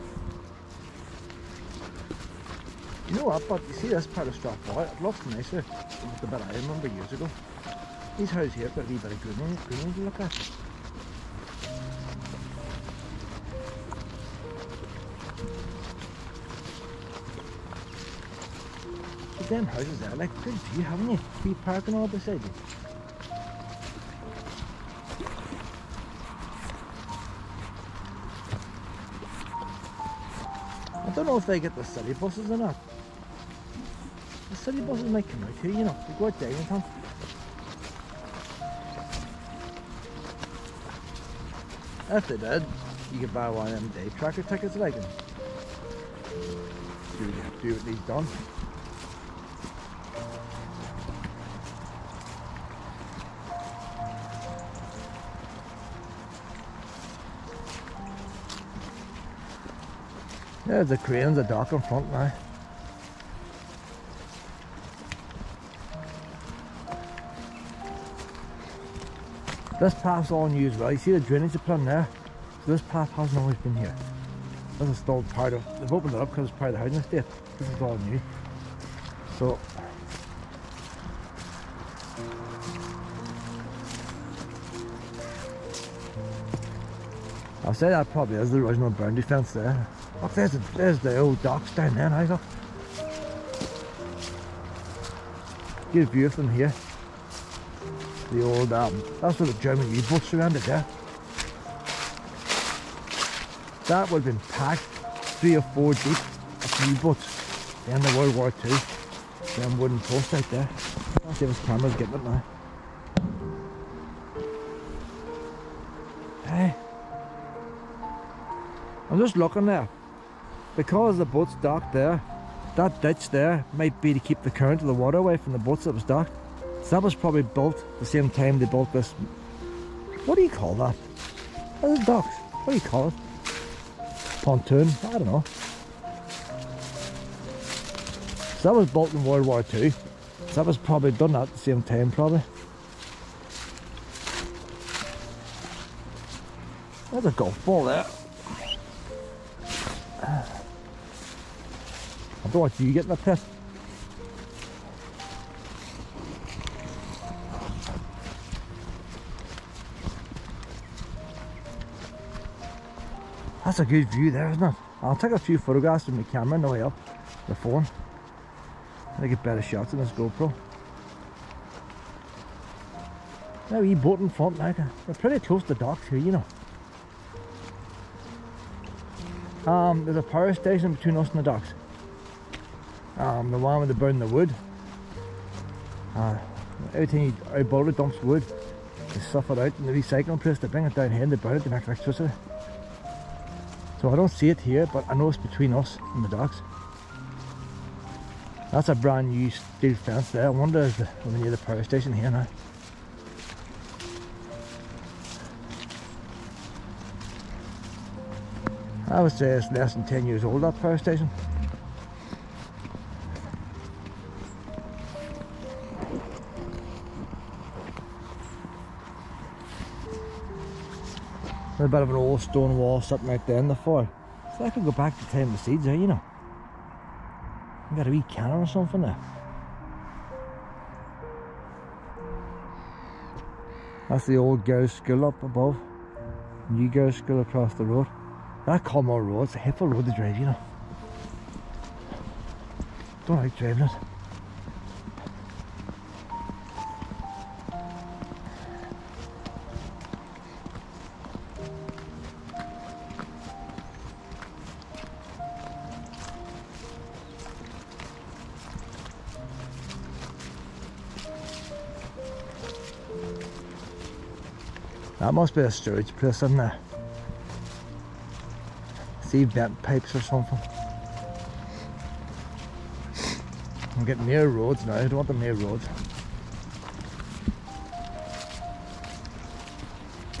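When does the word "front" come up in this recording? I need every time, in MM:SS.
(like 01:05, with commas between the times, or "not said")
01:01, 02:54.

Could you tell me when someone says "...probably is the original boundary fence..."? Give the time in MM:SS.
01:28.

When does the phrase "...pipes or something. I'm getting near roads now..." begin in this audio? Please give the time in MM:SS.
04:29.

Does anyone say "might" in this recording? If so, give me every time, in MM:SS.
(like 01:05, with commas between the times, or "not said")
00:35, 02:03.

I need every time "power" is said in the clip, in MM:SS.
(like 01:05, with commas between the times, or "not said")
03:00, 03:21, 03:30.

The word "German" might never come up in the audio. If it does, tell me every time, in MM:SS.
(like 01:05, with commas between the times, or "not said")
01:39.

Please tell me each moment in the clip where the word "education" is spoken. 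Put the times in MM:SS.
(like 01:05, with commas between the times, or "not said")
not said.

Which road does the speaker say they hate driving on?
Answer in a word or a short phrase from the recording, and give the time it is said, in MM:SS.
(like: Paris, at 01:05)
Culmore Road, at 03:58.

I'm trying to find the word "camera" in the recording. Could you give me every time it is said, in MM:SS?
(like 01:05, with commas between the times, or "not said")
01:51, 02:46.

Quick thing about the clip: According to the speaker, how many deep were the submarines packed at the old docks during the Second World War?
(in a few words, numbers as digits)
3 or 4.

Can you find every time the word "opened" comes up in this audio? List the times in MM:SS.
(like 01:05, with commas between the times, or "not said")
01:15.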